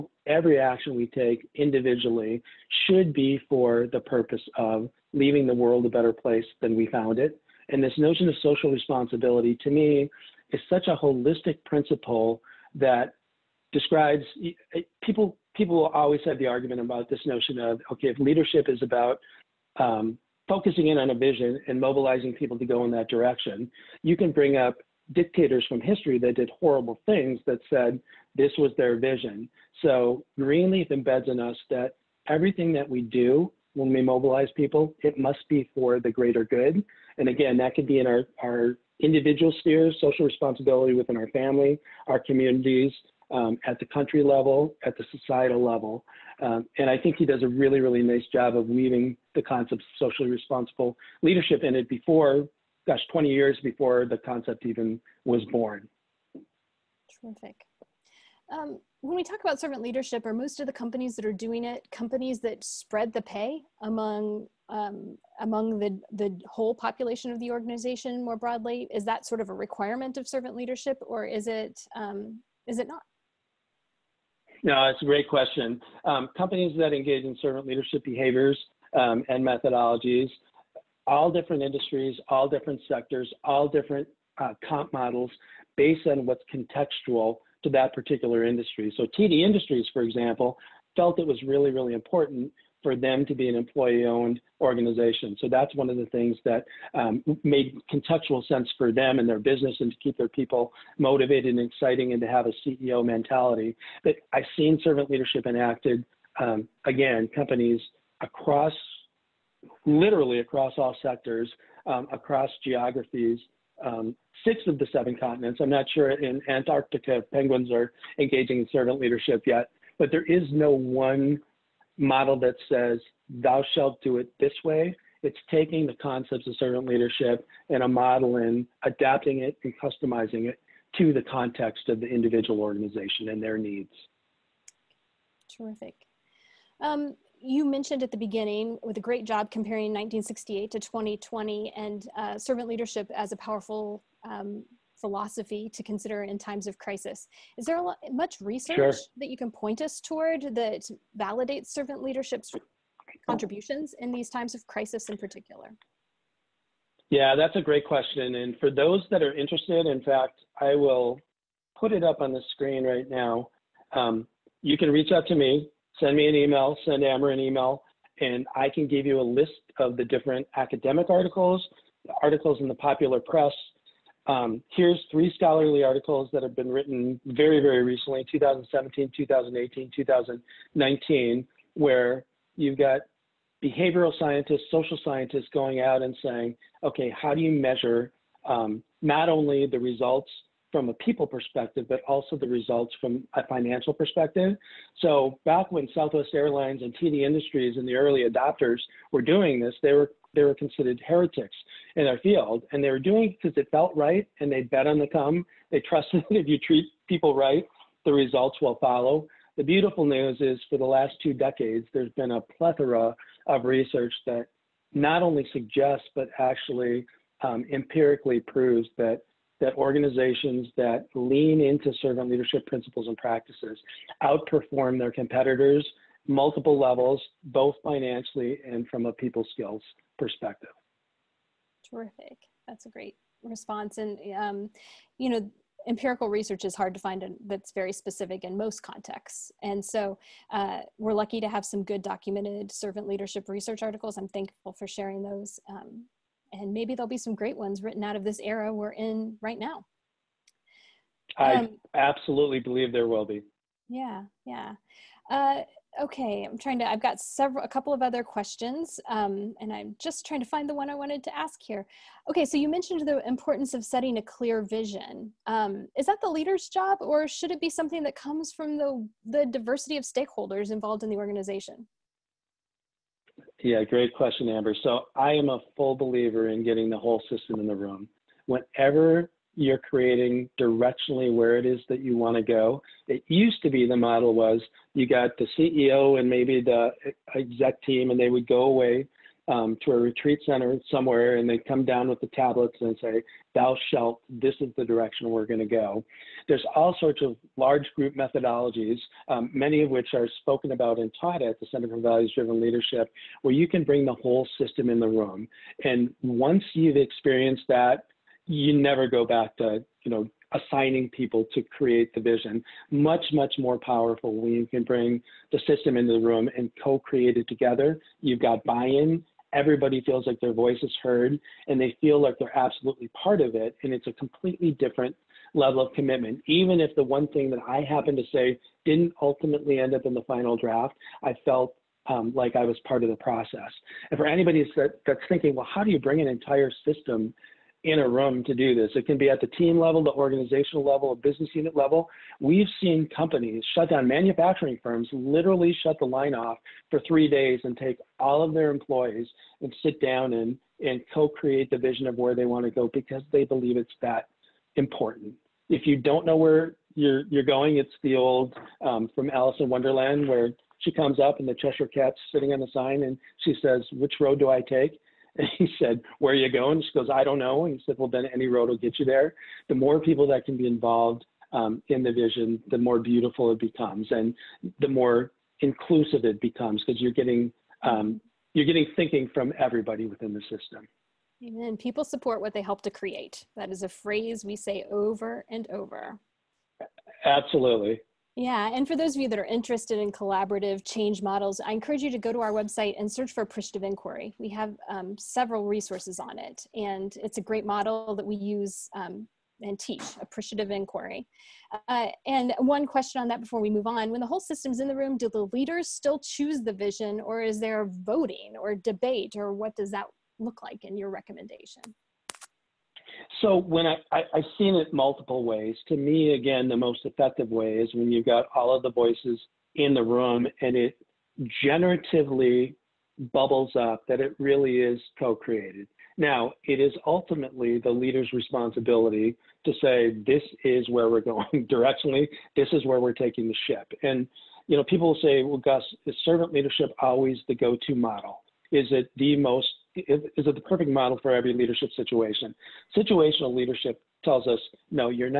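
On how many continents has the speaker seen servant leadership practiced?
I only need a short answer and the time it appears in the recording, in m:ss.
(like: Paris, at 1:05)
6, at 1:54.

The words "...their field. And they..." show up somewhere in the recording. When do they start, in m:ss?
3:22.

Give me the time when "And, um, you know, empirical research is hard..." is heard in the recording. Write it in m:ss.
3:53.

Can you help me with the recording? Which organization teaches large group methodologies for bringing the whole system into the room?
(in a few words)
Center for Values-Driven Leadership.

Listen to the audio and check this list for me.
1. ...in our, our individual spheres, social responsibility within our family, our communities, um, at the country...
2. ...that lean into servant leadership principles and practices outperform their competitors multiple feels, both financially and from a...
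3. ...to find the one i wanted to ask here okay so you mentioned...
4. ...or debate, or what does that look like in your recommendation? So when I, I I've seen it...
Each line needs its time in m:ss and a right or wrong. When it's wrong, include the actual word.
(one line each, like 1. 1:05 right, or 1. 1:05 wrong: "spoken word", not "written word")
1. 0:38 right
2. 3:40 wrong: "levels", not "feels"
3. 4:20 right
4. 6:48 right.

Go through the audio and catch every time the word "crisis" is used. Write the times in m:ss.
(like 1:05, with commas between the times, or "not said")
2:26, 2:34.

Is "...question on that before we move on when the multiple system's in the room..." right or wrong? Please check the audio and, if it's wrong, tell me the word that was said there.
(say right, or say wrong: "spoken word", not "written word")
wrong: "whole", not "multiple".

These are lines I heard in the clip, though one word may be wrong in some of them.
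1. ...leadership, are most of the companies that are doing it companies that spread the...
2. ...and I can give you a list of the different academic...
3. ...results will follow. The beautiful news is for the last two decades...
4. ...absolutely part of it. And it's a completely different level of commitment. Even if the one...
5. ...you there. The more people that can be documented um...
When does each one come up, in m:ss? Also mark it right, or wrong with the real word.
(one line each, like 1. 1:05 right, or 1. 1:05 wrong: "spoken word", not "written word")
1. 0:59 right
2. 2:48 right
3. 3:28 right
4. 5:22 right
5. 6:08 wrong: "involved", not "documented".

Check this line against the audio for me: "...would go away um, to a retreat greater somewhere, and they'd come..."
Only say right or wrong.
wrong.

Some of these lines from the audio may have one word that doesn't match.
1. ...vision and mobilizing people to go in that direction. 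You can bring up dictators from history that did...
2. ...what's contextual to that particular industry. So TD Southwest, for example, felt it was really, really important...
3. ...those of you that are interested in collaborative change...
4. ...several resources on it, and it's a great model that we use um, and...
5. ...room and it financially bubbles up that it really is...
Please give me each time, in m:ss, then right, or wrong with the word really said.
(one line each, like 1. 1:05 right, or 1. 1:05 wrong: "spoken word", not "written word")
1. 0:21 right
2. 1:26 wrong: "Industries", not "Southwest"
3. 6:28 right
4. 6:35 right
5. 7:00 wrong: "generatively", not "financially".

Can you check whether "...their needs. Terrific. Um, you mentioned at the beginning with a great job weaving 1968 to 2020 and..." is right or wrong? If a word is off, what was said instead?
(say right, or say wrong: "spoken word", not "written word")
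wrong: "comparing", not "weaving".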